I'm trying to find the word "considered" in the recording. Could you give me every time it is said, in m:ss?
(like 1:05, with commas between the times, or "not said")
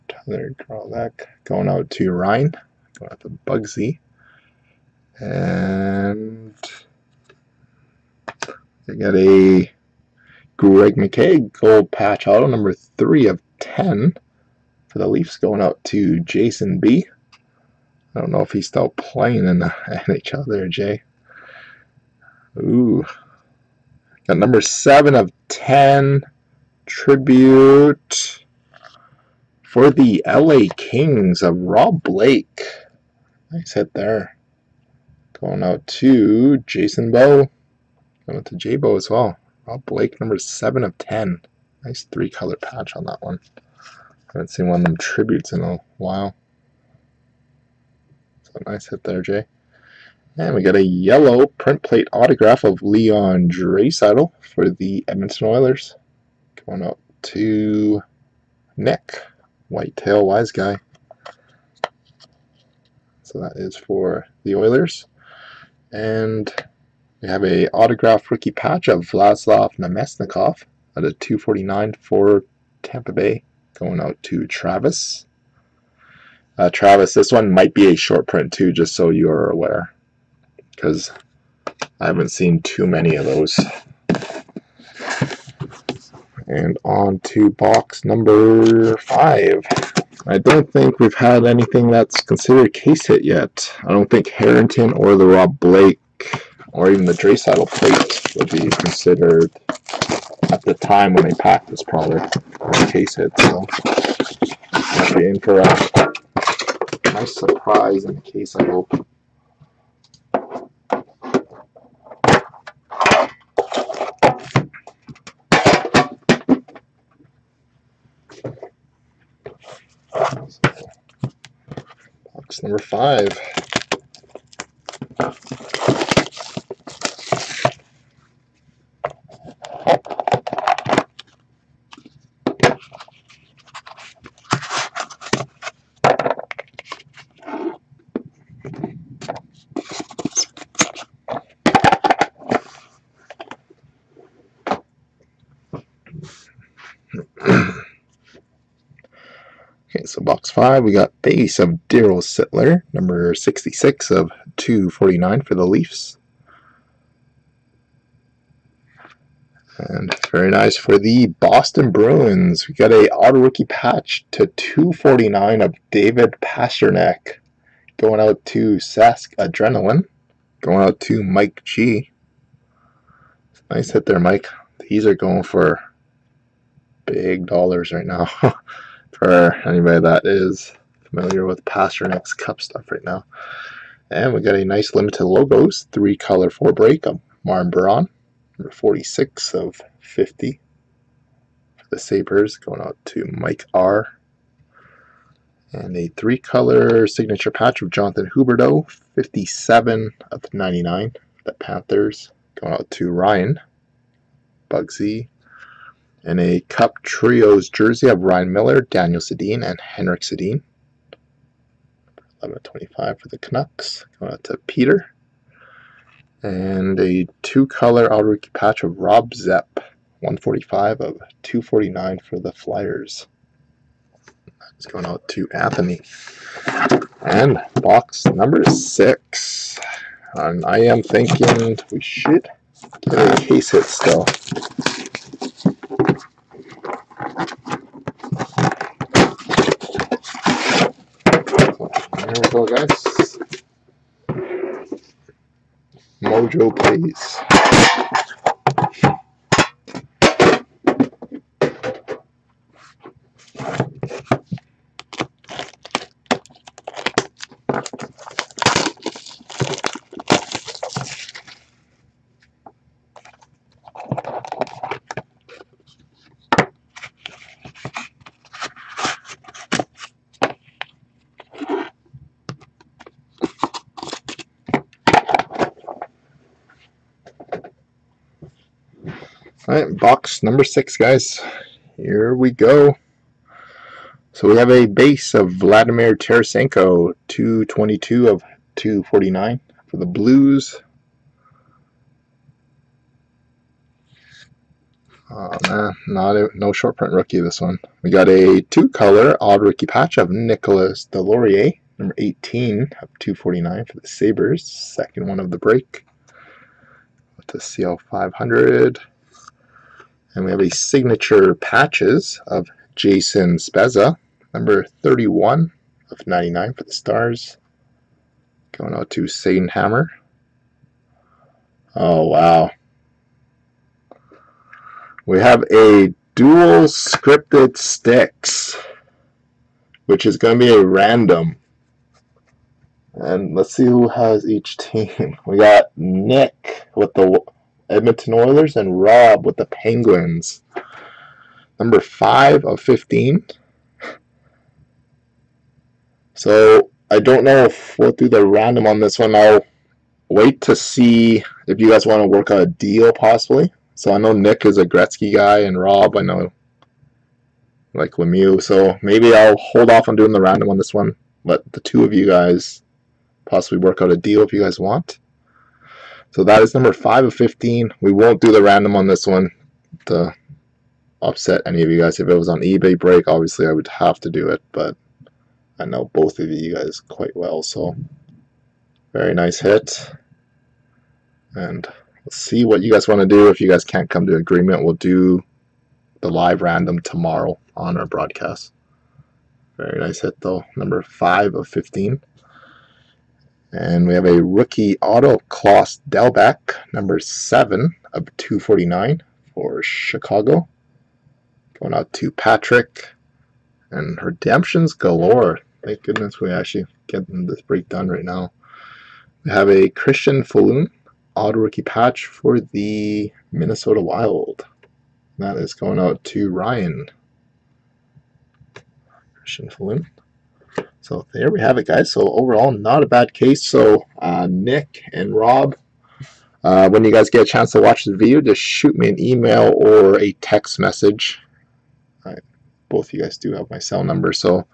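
1:32, 1:38.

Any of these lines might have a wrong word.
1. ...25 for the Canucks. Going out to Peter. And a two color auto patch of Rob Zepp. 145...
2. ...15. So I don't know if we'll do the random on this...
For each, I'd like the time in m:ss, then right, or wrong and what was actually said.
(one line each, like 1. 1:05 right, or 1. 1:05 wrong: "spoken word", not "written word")
1. 3:32 right
2. 5:42 right.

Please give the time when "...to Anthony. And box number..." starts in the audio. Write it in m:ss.
3:45.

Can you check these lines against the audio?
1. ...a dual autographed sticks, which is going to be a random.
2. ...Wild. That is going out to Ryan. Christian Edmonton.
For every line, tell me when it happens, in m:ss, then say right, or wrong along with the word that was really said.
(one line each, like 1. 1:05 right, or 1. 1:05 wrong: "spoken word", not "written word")
1. 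5:25 wrong: "scripted", not "autographed"
2. 6:54 wrong: "Folin", not "Edmonton".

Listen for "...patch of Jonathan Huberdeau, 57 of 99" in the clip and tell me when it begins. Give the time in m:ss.
3:17.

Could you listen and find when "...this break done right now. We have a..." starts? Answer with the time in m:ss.
6:47.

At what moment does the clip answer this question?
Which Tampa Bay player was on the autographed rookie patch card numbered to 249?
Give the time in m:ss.
1:09.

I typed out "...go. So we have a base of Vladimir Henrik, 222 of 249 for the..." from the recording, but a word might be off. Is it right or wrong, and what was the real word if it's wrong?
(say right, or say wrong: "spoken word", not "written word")
wrong: "Tarasenko", not "Henrik".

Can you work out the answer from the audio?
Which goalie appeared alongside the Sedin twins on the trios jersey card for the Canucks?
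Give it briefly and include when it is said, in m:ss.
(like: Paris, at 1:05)
Ryan Miller, at 3:28.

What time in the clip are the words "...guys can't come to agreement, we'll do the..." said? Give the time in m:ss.
6:23.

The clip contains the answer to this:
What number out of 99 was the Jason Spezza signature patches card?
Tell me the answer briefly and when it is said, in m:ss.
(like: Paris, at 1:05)
31, at 5:15.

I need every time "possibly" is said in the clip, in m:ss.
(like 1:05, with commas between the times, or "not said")
5:53, 6:03.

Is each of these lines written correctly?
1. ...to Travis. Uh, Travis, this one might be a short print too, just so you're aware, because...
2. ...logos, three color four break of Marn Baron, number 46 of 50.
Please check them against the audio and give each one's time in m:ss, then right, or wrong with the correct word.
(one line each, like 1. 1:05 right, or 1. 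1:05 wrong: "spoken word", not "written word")
1. 1:14 right
2. 3:05 right.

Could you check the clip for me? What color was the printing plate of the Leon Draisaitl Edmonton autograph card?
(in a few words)
Yellow.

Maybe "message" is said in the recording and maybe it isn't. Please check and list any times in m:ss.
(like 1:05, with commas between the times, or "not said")
7:10.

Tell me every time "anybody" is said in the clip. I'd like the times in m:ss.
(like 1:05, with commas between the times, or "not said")
2:59.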